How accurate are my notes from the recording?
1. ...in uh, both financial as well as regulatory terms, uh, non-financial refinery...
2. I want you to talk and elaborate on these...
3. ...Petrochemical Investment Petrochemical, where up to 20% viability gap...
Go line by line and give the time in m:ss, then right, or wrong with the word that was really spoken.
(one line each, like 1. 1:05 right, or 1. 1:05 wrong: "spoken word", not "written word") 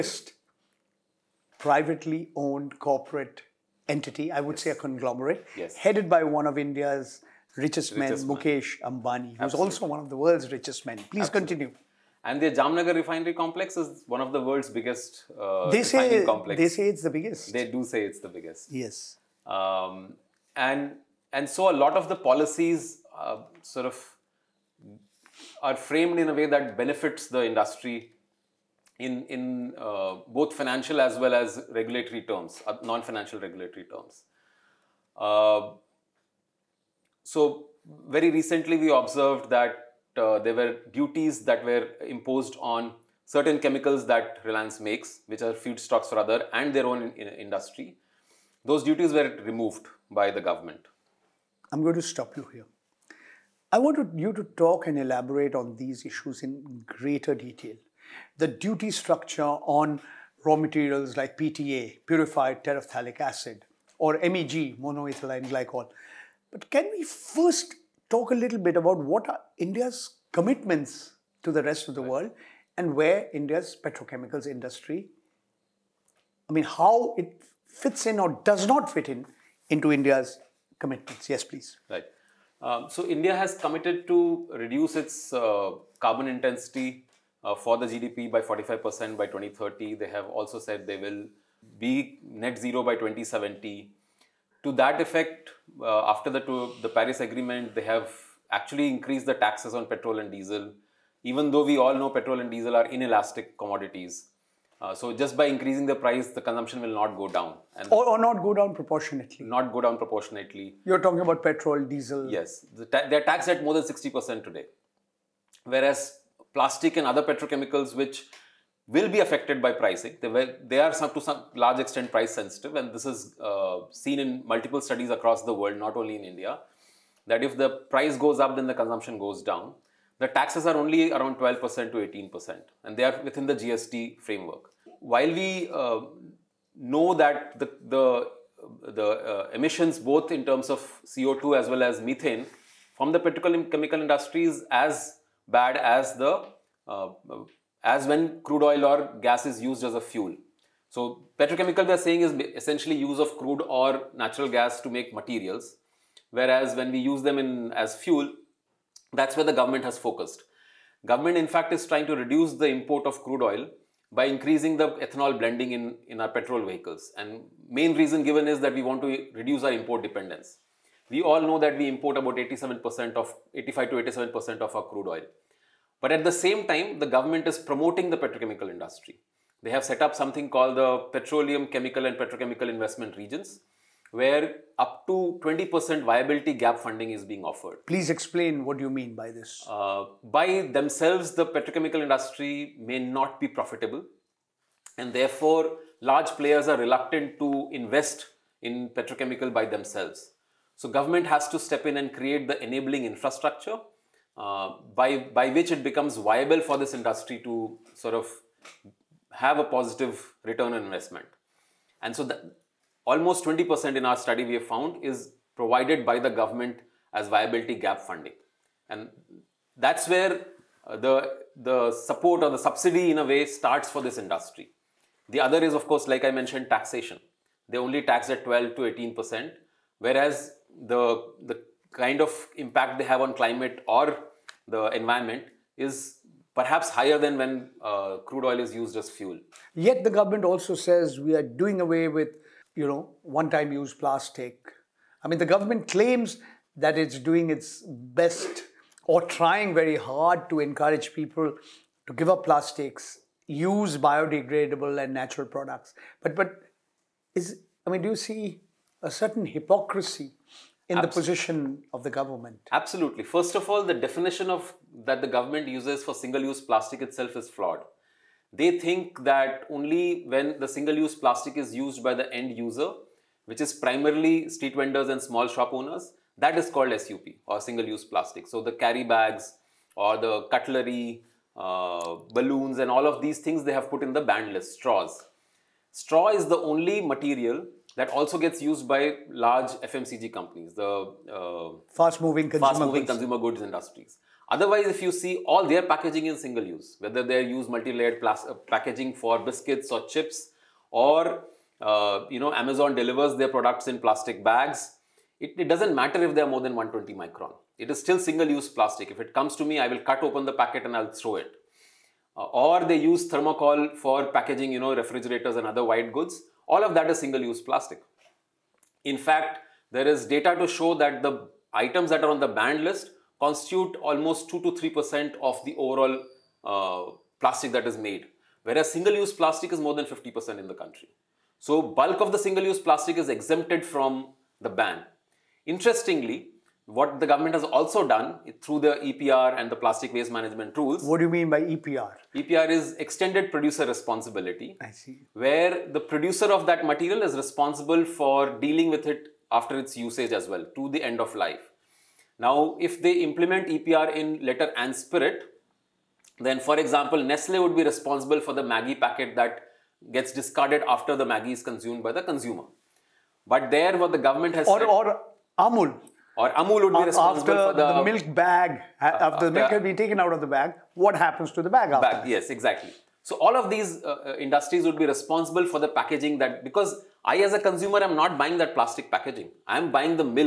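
1. 0:29 wrong: "regulatory", not "refinery"
2. 0:53 right
3. 3:02 wrong: "Regions", not "Petrochemical".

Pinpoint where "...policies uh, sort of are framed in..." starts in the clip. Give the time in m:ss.
0:22.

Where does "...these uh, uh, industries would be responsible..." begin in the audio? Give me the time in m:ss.
6:13.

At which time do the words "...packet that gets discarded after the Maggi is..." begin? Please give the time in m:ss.
5:58.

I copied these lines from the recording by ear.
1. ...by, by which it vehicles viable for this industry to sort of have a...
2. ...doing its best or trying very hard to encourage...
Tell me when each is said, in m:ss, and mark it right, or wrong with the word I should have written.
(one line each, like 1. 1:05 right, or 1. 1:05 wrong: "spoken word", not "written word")
1. 3:24 wrong: "becomes", not "vehicles"
2. 4:07 right.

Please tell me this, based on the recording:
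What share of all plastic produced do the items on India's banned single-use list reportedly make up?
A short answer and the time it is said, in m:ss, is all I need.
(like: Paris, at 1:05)
2 to 3%, at 5:24.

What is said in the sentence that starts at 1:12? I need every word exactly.
world and where India's petrochemicals industry, I mean, how it fits in or does not fit in into India's commitments.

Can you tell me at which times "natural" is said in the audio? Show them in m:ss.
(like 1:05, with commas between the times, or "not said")
2:34, 4:15.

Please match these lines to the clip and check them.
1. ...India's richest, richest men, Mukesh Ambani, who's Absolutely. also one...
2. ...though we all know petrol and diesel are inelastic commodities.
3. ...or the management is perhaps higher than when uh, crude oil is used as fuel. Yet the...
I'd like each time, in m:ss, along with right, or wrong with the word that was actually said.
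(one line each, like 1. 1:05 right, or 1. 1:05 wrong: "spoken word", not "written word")
1. 0:06 right
2. 1:41 right
3. 3:53 wrong: "environment", not "management".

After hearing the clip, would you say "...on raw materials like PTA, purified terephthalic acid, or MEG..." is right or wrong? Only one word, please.
right.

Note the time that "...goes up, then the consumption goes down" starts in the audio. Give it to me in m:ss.
2:08.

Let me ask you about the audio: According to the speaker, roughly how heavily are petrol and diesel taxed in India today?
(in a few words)
more than 60%.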